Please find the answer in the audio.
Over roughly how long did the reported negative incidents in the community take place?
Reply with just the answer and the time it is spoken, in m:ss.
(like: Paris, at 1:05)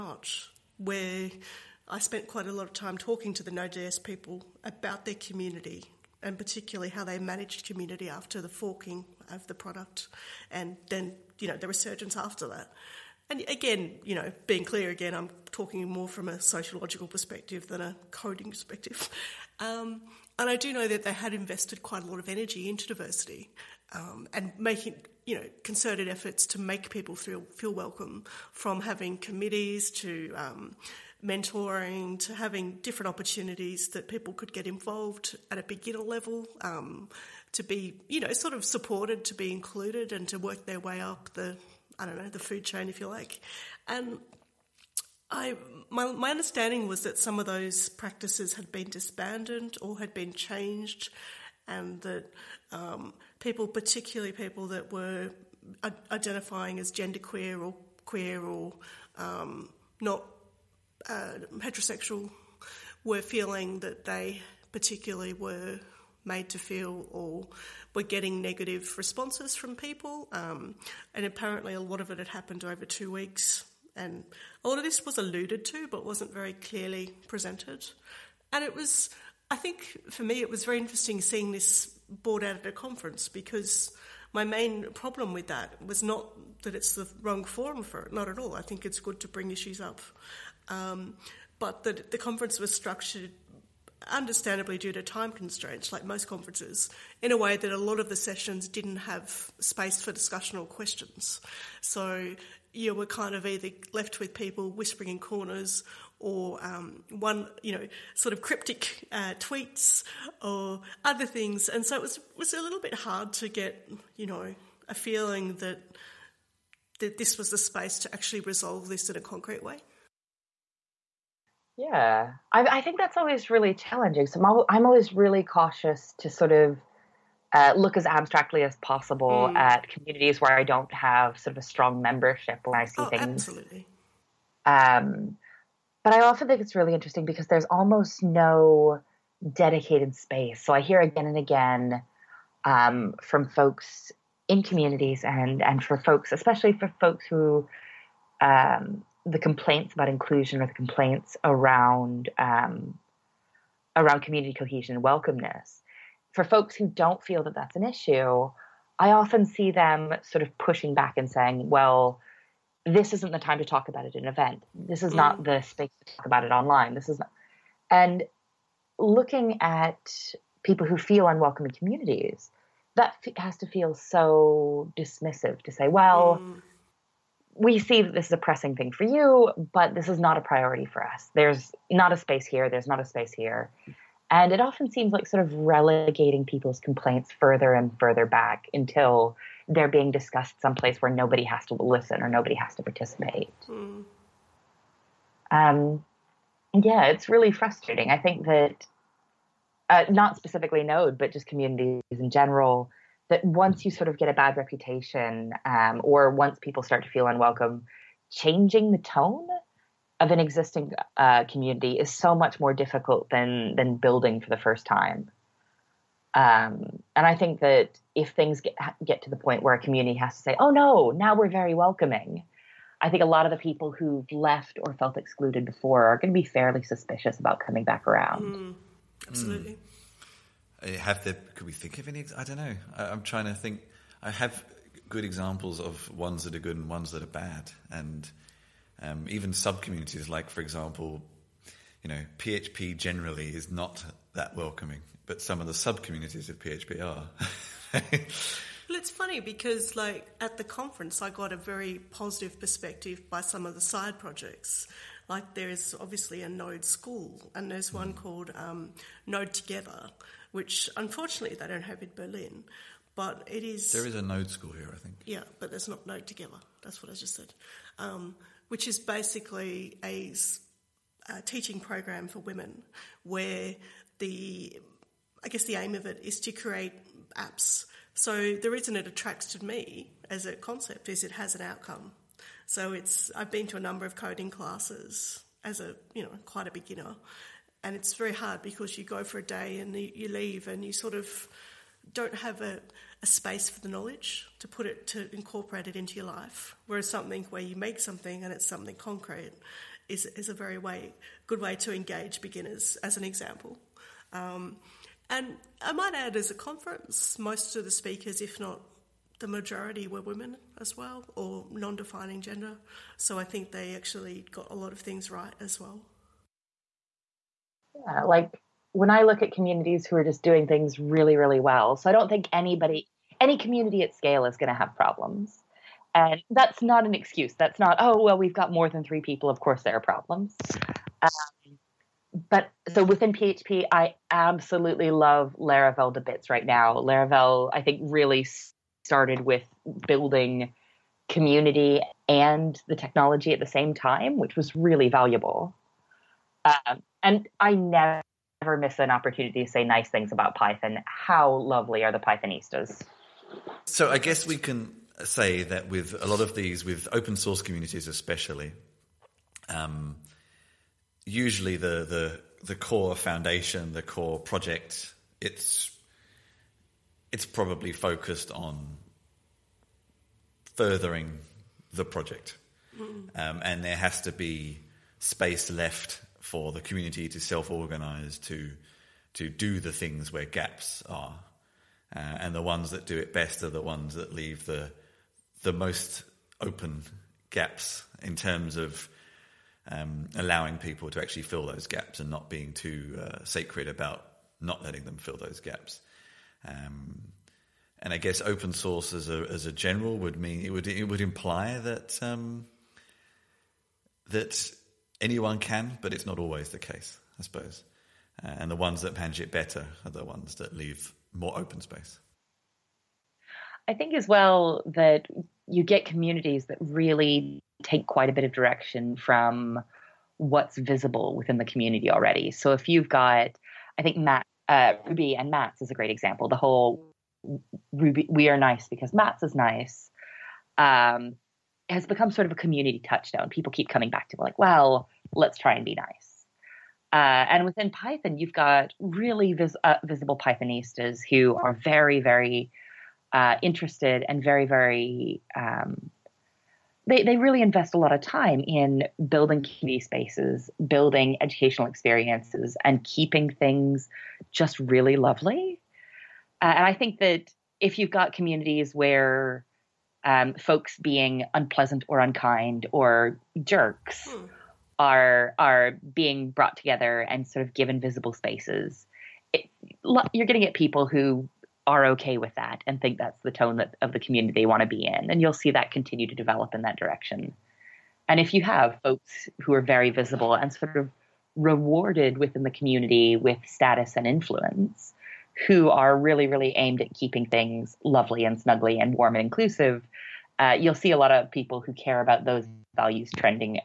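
2 weeks, at 1:12.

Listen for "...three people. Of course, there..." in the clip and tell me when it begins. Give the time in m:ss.
5:29.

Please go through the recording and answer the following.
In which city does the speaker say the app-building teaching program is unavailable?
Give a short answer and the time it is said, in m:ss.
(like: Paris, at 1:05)
Berlin, at 4:22.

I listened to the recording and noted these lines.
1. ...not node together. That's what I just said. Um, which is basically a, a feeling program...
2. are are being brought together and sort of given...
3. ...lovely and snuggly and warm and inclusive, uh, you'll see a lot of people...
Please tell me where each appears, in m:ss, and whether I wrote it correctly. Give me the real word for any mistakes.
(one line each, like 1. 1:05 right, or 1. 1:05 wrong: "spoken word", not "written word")
1. 4:25 wrong: "teaching", not "feeling"
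2. 7:44 right
3. 8:08 right.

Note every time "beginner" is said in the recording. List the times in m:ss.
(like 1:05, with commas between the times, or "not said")
0:35, 4:46, 5:02.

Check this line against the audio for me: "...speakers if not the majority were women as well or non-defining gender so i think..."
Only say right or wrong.
right.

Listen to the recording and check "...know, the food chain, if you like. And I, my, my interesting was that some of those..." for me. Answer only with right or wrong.
wrong.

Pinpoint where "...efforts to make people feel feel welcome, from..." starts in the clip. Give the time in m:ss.
0:26.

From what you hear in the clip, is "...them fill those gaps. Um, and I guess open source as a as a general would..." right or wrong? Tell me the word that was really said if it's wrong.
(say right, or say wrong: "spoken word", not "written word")
right.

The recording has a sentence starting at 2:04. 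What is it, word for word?
So I'm, always really cautious to sort of uh, look as abstractly as possible mm.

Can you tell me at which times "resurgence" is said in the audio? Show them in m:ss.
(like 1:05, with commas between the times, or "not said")
0:11.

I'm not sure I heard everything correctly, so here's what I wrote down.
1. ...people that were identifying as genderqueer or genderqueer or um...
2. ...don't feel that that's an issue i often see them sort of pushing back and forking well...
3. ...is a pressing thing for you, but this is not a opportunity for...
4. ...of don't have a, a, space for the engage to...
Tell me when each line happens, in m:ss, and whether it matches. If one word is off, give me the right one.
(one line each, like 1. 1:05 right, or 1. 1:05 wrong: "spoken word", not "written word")
1. 0:54 wrong: "queer", not "genderqueer"
2. 2:36 wrong: "saying", not "forking"
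3. 2:58 wrong: "priority", not "opportunity"
4. 4:51 wrong: "knowledge", not "engage".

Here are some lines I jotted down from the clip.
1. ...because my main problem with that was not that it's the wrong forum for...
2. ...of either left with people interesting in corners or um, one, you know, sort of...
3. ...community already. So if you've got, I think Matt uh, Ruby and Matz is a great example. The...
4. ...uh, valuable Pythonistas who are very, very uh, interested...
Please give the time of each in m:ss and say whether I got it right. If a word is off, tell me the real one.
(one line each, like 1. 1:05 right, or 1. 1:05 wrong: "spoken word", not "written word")
1. 1:23 right
2. 1:43 wrong: "whispering", not "interesting"
3. 7:01 right
4. 7:19 wrong: "visible", not "valuable".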